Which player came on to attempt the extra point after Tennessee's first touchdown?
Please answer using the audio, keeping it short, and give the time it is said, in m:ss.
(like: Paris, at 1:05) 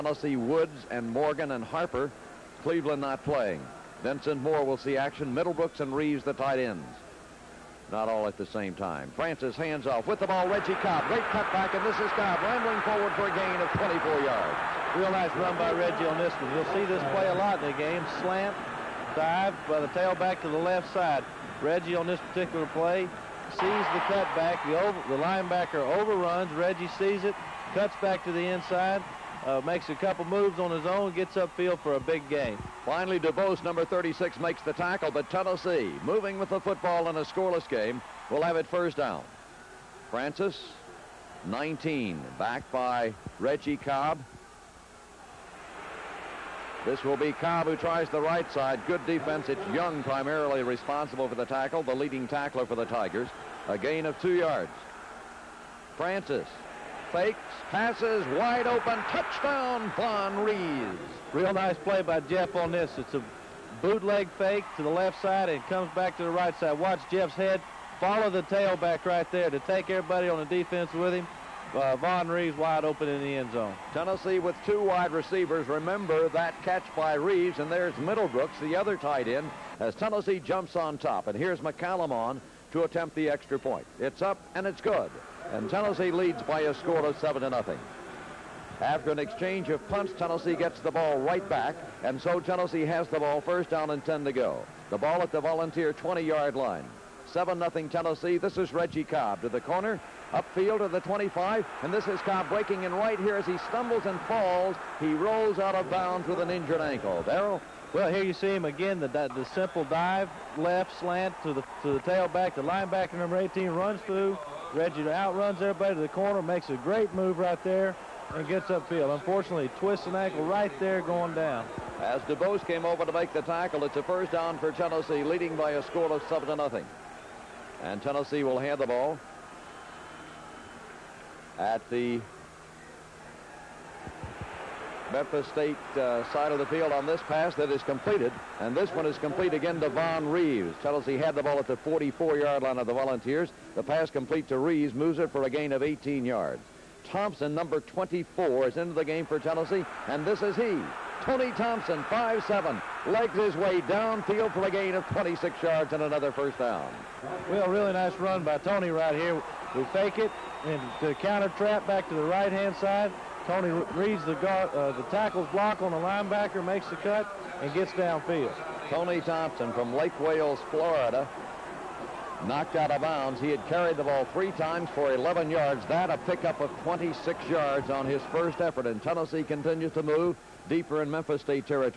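McCallum, at 1:21.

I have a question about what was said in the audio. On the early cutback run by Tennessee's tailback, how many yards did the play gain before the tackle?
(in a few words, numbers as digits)
24.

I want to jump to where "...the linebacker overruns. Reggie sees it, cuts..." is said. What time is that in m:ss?
0:25.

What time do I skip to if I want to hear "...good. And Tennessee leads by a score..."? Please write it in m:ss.
1:24.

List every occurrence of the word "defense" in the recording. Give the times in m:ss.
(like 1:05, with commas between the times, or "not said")
0:49, 1:10.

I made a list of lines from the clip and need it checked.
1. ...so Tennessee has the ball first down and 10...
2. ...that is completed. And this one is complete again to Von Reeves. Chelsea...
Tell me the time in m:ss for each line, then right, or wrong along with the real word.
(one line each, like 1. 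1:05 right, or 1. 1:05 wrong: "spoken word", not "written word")
1. 1:32 right
2. 2:17 right.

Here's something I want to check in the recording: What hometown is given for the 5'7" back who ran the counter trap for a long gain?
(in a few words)
Lake Wales, Florida.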